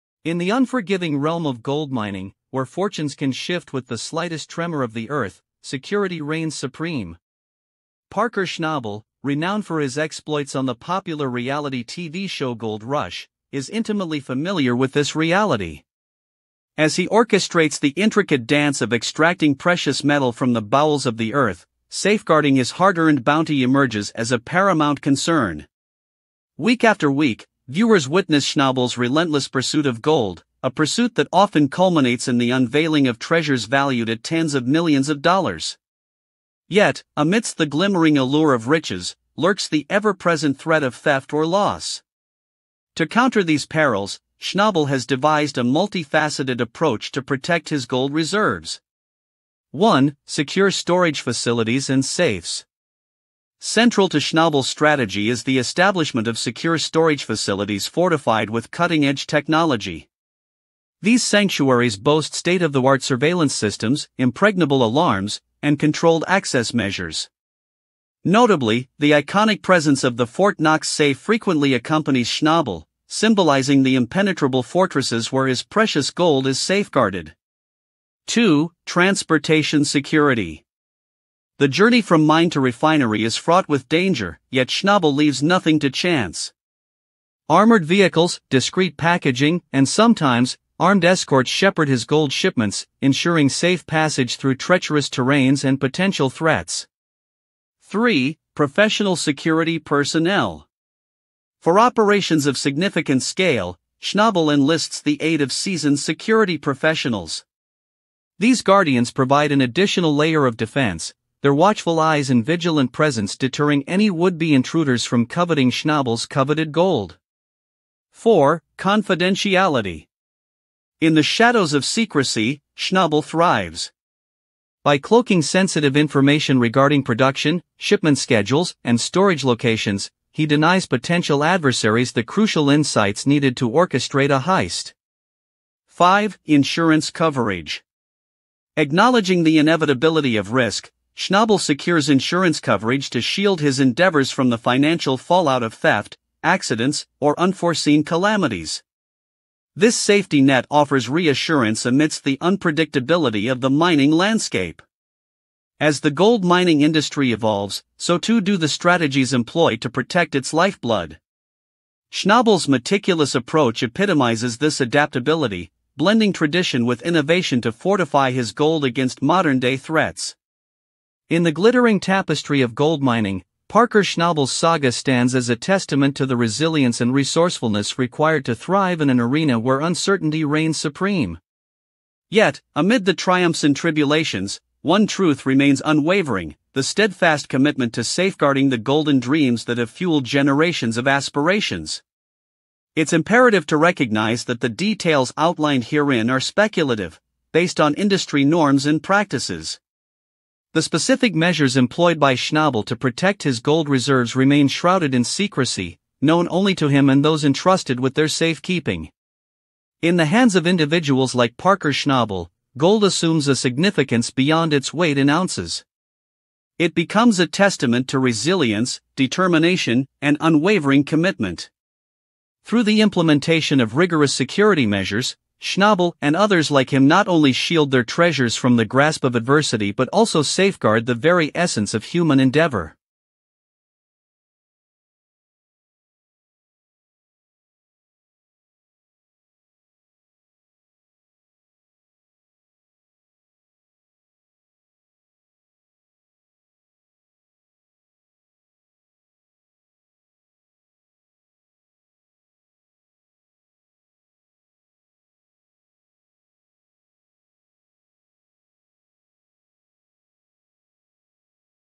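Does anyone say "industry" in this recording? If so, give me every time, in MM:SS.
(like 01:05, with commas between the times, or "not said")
02:36, 03:17.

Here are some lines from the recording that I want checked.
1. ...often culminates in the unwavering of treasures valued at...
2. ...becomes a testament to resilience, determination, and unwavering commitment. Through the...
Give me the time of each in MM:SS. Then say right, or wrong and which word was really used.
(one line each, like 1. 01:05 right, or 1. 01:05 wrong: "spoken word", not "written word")
1. 00:31 wrong: "unveiling", not "unwavering"
2. 03:36 right.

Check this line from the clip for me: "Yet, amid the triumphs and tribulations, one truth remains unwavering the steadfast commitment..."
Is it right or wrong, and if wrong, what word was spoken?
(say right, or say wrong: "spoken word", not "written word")
right.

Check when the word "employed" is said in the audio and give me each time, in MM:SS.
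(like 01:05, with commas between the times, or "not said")
02:39, 03:21.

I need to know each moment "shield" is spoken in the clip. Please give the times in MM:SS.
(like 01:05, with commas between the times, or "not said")
02:23, 03:47.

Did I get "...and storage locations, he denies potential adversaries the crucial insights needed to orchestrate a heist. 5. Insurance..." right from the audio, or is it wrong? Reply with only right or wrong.
right.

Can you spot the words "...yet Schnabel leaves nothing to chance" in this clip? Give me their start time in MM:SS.
01:24.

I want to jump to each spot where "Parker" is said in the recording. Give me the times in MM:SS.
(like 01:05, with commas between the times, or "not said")
00:08, 02:53, 03:31.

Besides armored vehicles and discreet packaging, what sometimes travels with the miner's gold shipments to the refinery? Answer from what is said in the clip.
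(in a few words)
armed escorts.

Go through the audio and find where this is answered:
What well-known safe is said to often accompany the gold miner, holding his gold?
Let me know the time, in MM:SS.
01:10.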